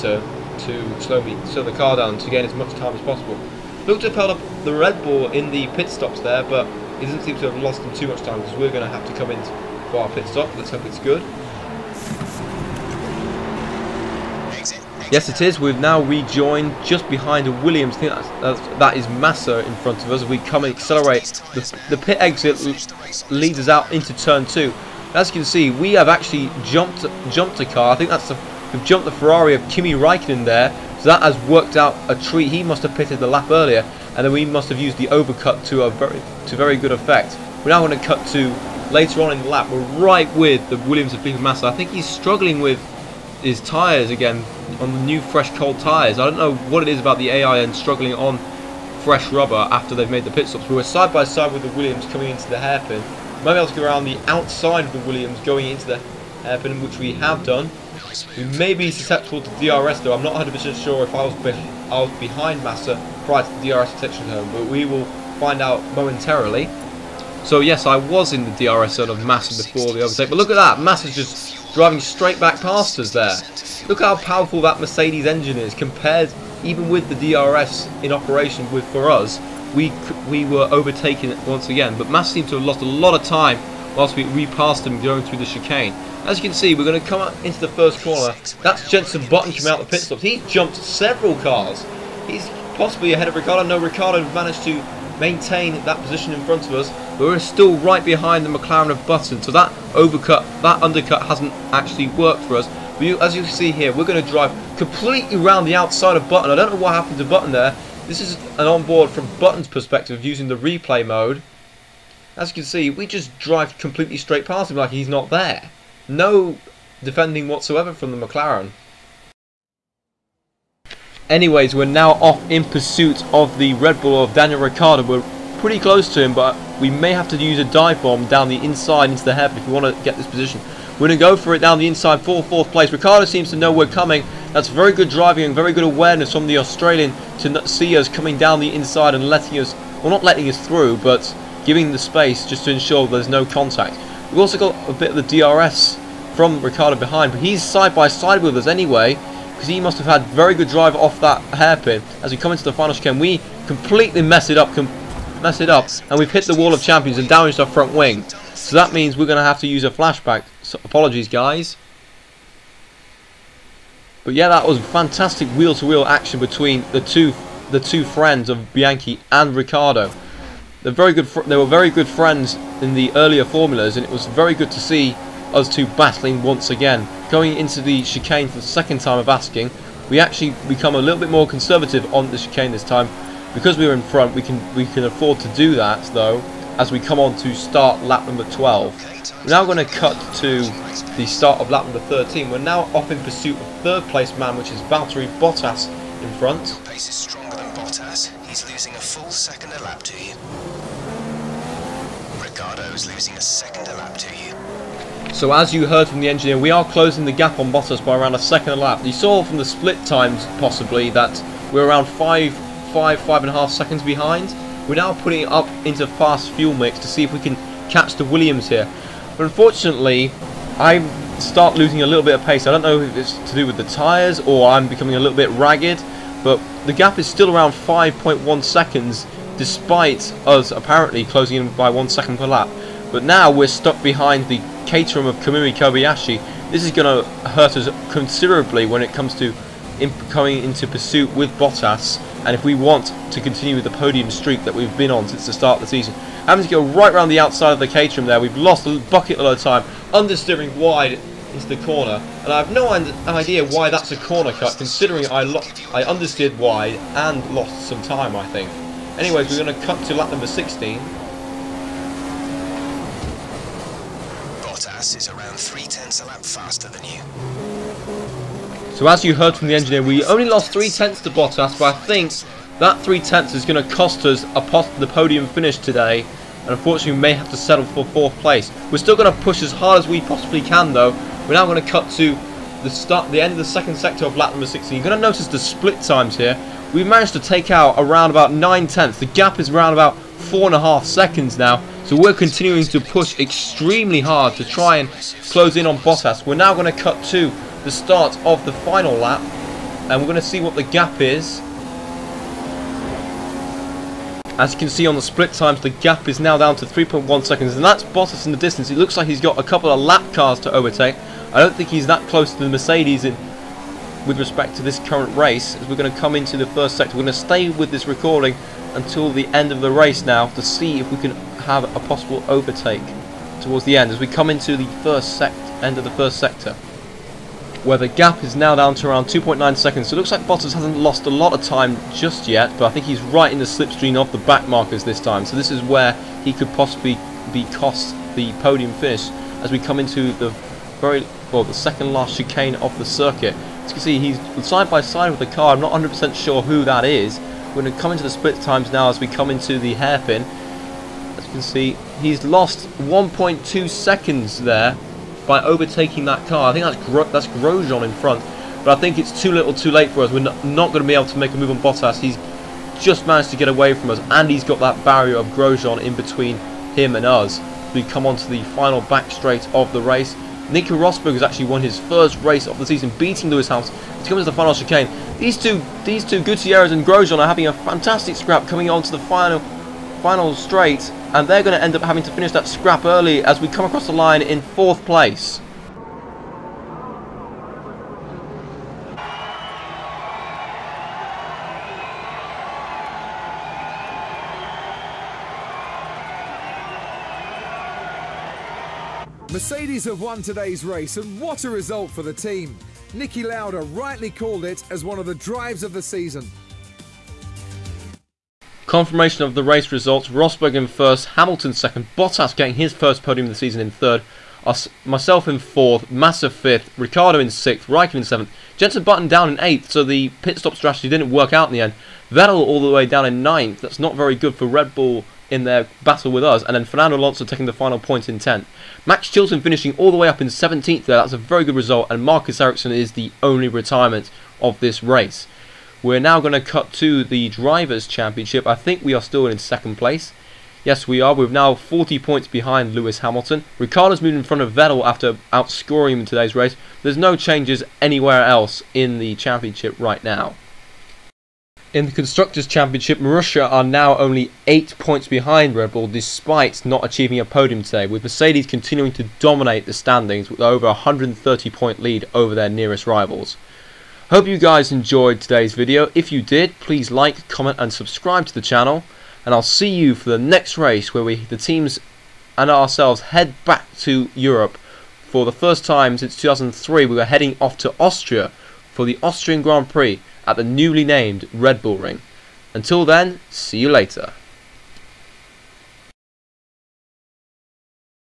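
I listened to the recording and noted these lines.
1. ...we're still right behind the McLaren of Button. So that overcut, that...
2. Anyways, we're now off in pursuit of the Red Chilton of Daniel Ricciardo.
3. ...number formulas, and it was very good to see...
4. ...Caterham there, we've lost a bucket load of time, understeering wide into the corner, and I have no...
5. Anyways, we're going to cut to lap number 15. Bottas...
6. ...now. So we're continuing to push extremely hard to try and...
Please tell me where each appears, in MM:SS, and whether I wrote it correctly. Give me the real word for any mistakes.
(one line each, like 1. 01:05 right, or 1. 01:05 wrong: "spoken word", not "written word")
1. 01:37 right
2. 02:01 wrong: "Bull", not "Chilton"
3. 02:53 wrong: "earlier", not "number"
4. 04:07 right
5. 04:19 wrong: "16", not "15"
6. 04:51 right.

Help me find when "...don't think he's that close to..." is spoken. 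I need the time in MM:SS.
05:11.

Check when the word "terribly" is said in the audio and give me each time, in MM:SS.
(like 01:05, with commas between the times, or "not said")
not said.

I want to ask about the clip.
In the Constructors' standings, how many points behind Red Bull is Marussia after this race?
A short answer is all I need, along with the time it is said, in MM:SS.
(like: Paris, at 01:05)
8, at 07:34.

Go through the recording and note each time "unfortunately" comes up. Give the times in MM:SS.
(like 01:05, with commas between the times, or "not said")
03:39, 04:36.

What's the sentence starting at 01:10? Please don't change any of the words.
Massa's just driving straight back past us there.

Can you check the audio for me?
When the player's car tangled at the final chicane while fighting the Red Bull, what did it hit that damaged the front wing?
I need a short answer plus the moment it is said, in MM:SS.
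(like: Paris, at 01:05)
wall of champions, at 02:36.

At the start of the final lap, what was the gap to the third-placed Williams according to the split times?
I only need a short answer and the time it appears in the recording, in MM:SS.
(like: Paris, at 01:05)
3.1 seconds, at 05:06.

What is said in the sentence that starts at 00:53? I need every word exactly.
Might be able to go around the outside of the Williams going into the hairpin, which we have done.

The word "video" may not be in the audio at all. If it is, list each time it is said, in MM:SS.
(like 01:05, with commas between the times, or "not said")
07:45.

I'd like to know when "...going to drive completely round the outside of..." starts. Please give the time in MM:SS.
01:44.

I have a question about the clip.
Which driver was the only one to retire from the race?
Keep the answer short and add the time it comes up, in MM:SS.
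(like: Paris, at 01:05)
Marcus Ericsson, at 07:12.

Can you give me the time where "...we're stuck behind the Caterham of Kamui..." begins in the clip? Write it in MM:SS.
03:53.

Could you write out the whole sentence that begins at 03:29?
You saw from the split times, possibly, that we're around five five, five and a half seconds behind.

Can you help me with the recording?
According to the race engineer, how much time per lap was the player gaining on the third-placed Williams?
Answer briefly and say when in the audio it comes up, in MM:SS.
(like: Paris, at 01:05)
a full second, at 03:18.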